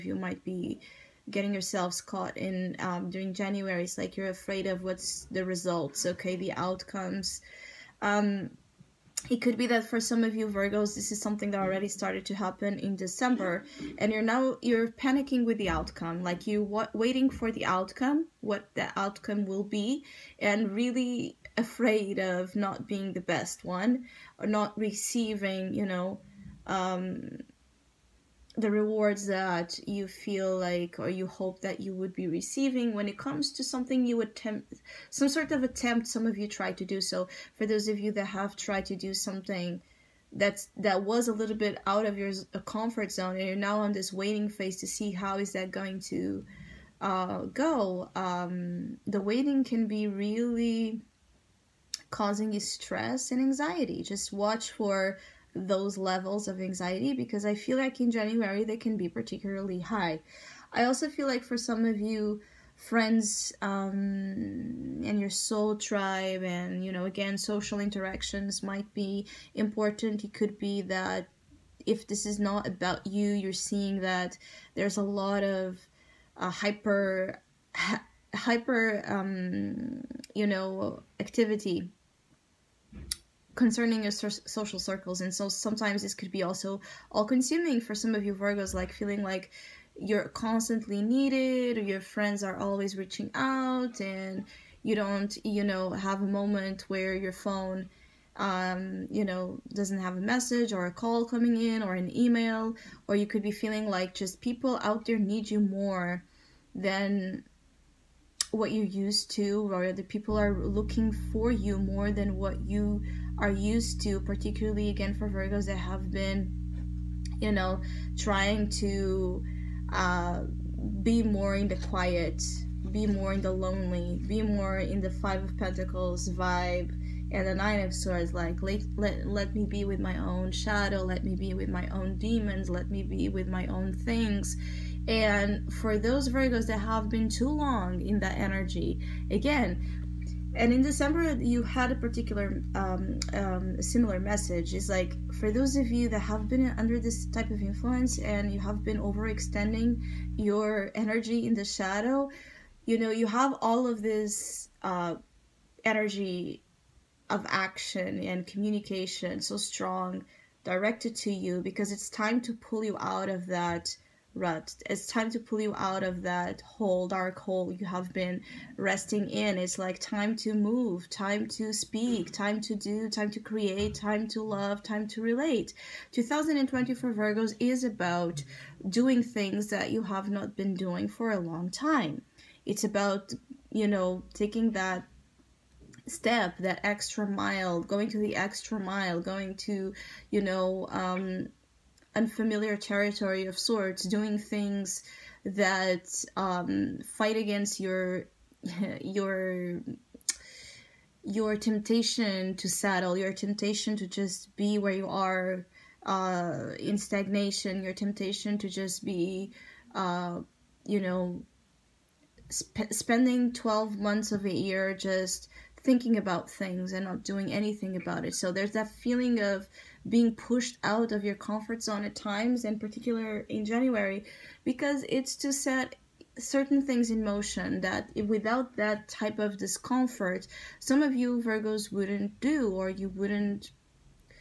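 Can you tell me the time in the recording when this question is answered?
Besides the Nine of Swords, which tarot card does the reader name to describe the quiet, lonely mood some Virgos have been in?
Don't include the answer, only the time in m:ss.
2:05.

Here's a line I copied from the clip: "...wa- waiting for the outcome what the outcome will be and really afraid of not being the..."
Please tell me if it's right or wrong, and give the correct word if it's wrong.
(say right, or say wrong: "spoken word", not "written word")
right.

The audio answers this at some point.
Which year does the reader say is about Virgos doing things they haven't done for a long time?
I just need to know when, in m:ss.
2:56.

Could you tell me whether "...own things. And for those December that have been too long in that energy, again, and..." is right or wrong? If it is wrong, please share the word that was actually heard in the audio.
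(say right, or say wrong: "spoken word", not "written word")
wrong: "Virgos", not "December".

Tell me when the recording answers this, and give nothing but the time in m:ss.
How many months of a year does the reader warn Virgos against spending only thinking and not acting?
3:33.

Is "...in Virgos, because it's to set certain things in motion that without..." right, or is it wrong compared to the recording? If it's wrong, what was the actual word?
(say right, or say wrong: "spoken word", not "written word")
wrong: "January", not "Virgos".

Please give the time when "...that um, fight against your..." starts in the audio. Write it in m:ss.
3:15.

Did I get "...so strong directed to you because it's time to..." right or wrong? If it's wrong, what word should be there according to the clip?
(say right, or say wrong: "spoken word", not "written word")
right.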